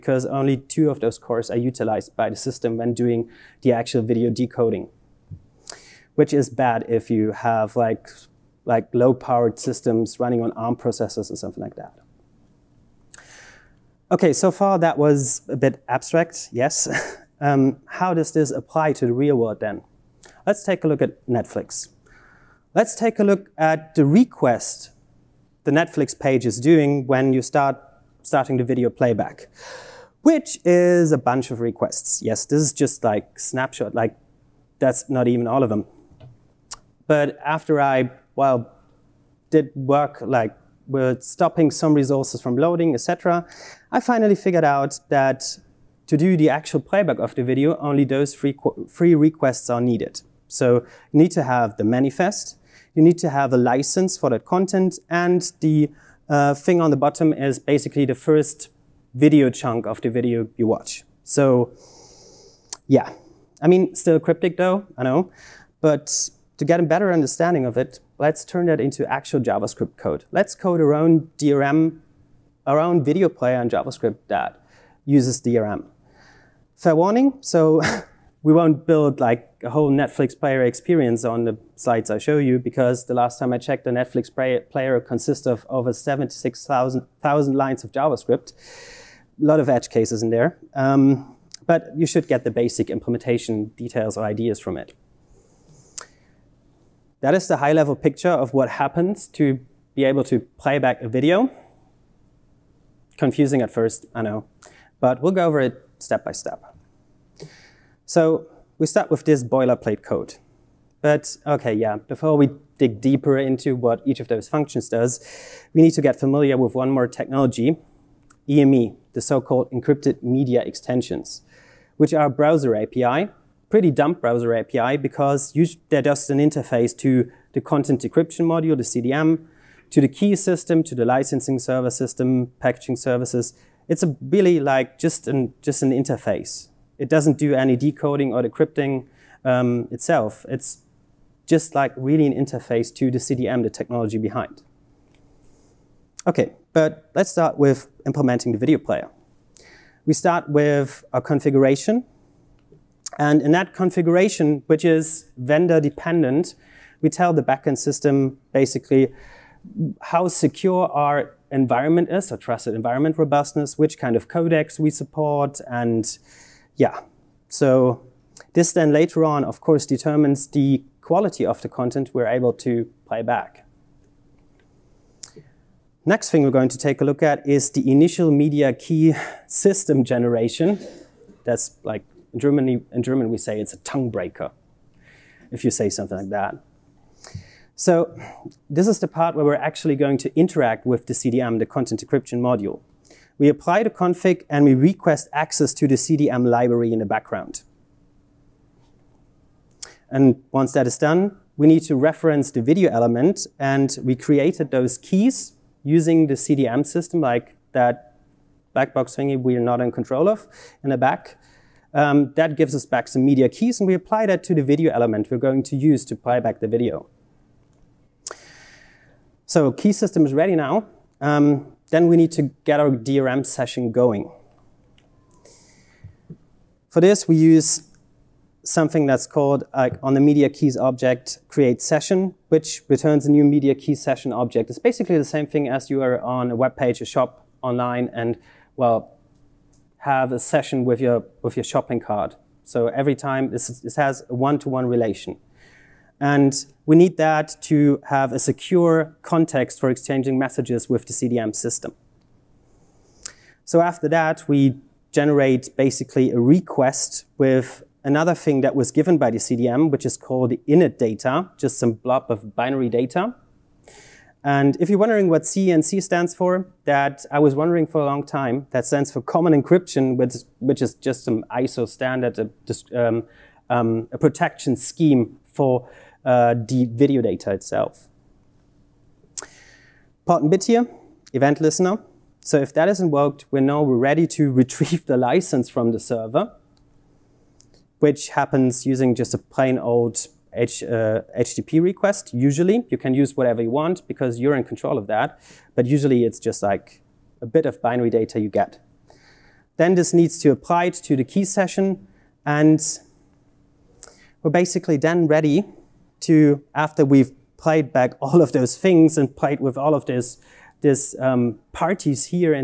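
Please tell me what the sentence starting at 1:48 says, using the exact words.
So we start with this boilerplate code.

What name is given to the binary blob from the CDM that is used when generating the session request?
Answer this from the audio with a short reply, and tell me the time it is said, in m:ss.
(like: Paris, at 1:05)
init data, at 4:20.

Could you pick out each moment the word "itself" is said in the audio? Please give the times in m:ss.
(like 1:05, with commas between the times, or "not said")
2:19, 4:37.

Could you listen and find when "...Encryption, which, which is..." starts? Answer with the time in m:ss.
4:29.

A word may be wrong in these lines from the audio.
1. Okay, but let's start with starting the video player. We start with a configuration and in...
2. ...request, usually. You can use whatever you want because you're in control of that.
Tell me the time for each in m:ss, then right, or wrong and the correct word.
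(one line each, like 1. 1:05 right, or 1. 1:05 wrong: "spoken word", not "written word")
1. 2:26 wrong: "implementing", not "starting"
2. 4:51 right.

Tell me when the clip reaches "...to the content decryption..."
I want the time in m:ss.
2:06.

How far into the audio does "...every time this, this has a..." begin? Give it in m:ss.
4:02.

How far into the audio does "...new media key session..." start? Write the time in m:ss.
3:53.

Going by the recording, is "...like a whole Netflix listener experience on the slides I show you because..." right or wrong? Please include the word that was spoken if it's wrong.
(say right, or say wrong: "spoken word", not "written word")
wrong: "player", not "listener".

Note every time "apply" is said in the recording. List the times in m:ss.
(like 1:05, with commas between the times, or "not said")
0:18, 3:13, 3:33, 5:00.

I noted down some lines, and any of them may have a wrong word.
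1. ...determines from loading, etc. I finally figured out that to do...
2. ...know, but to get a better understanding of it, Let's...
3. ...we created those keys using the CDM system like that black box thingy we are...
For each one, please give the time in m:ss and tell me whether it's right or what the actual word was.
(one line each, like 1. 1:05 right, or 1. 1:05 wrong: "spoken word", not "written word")
1. 0:41 wrong: "resources", not "determines"
2. 1:05 right
3. 3:24 right.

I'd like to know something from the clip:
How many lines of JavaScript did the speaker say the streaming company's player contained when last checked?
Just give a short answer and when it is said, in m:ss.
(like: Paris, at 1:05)
76,000, at 1:25.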